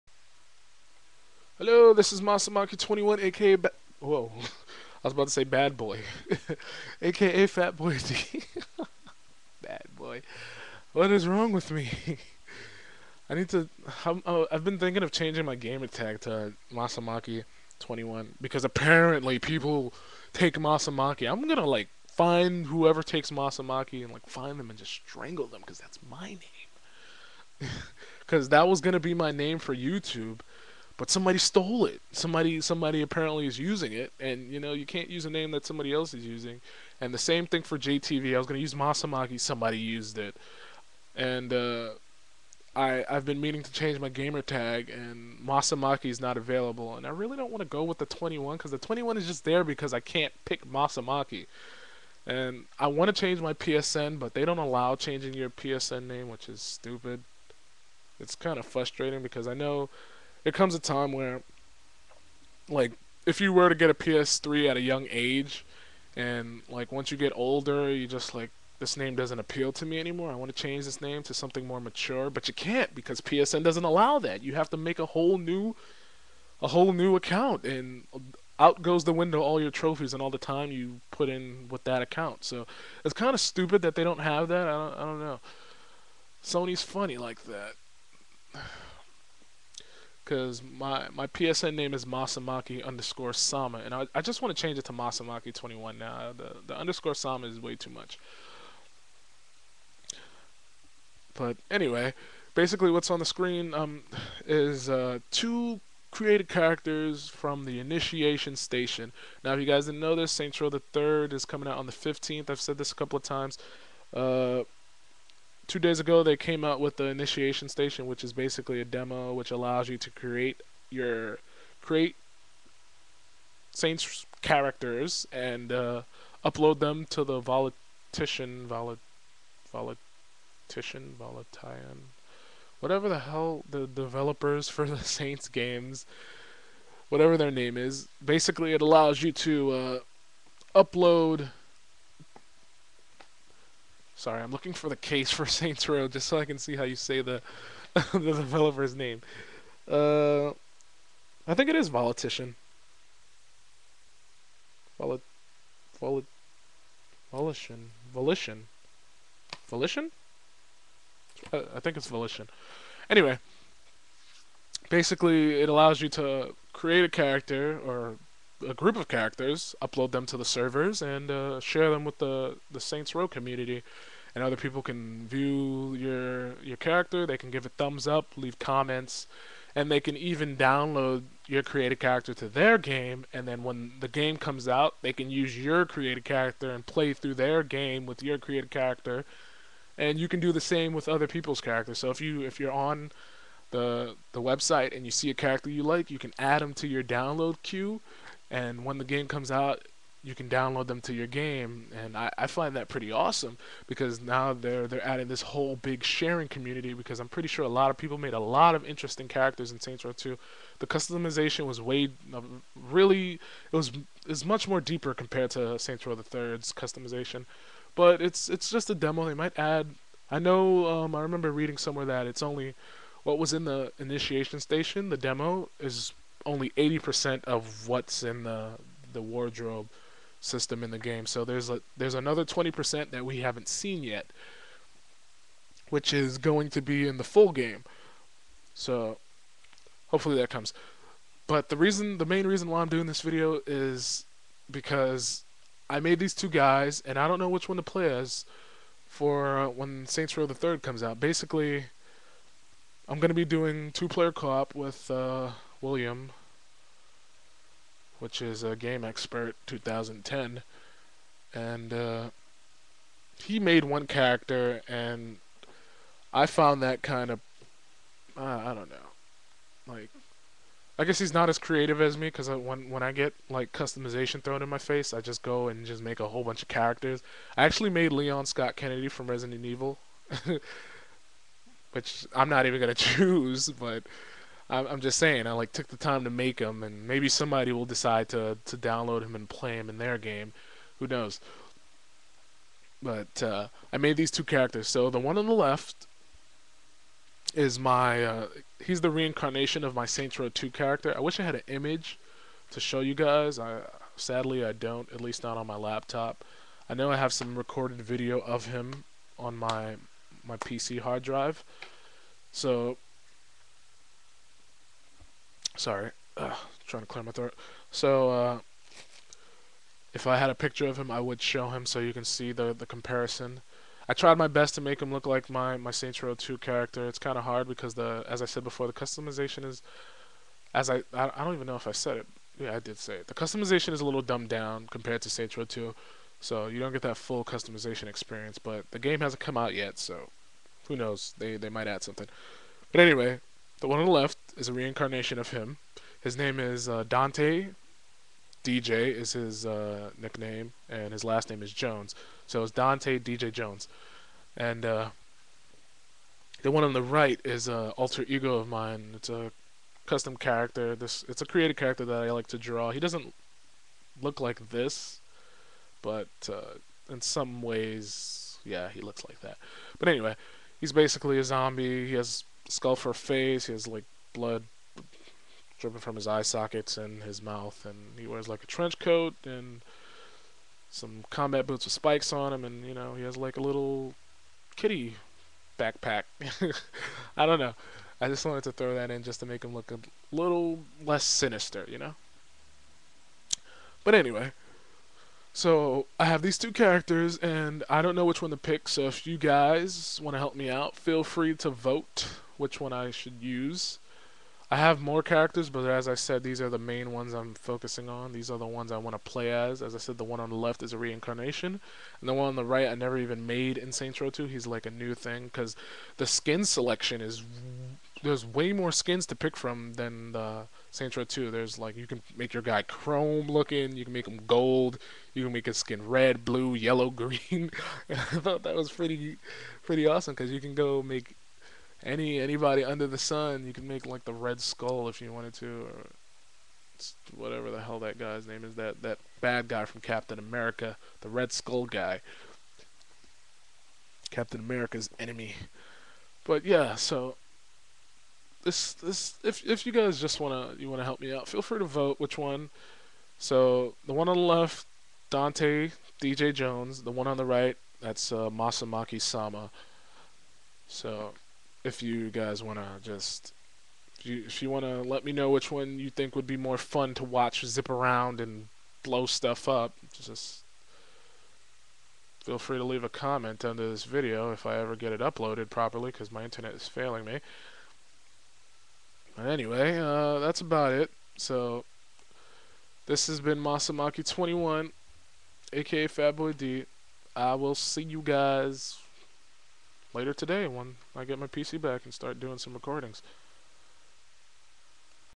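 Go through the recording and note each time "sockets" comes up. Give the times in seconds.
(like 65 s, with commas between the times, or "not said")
376 s.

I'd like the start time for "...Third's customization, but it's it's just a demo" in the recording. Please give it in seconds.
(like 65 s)
216 s.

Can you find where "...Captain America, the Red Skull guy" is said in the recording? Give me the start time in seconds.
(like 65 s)
440 s.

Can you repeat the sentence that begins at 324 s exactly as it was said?
I tried my best to make him look like my, my Saints Row 2 character.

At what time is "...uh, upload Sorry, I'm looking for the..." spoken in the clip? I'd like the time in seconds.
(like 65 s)
139 s.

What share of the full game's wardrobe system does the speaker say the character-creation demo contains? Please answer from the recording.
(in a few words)
80%.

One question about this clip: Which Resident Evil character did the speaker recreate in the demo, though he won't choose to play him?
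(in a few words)
Leon Scott Kennedy.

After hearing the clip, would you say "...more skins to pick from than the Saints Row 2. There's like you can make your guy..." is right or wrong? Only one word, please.
right.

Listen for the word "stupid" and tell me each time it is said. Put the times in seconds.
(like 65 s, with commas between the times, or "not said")
56 s, 83 s.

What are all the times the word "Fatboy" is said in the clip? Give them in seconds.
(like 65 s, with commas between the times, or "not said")
486 s.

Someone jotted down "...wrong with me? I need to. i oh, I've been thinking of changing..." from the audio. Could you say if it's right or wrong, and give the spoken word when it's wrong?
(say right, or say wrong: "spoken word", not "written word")
right.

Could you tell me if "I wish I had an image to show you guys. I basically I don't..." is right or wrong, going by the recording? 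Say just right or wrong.
wrong.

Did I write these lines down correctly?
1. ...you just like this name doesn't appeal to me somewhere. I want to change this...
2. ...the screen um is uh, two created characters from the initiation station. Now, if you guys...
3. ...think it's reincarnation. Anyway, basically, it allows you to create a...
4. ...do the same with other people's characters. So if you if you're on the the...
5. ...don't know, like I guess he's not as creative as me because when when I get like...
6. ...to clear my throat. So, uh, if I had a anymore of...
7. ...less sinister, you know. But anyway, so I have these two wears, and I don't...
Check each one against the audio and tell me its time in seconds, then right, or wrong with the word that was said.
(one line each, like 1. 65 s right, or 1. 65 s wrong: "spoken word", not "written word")
1. 67 s wrong: "anymore", not "somewhere"
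2. 103 s right
3. 161 s wrong: "volition", not "reincarnation"
4. 190 s right
5. 268 s right
6. 317 s wrong: "picture", not "anymore"
7. 391 s wrong: "characters", not "wears".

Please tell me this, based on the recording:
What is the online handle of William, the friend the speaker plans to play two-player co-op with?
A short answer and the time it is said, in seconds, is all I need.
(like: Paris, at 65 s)
Game Expert 2010, at 258 s.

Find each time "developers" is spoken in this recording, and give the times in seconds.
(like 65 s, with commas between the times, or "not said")
133 s, 148 s.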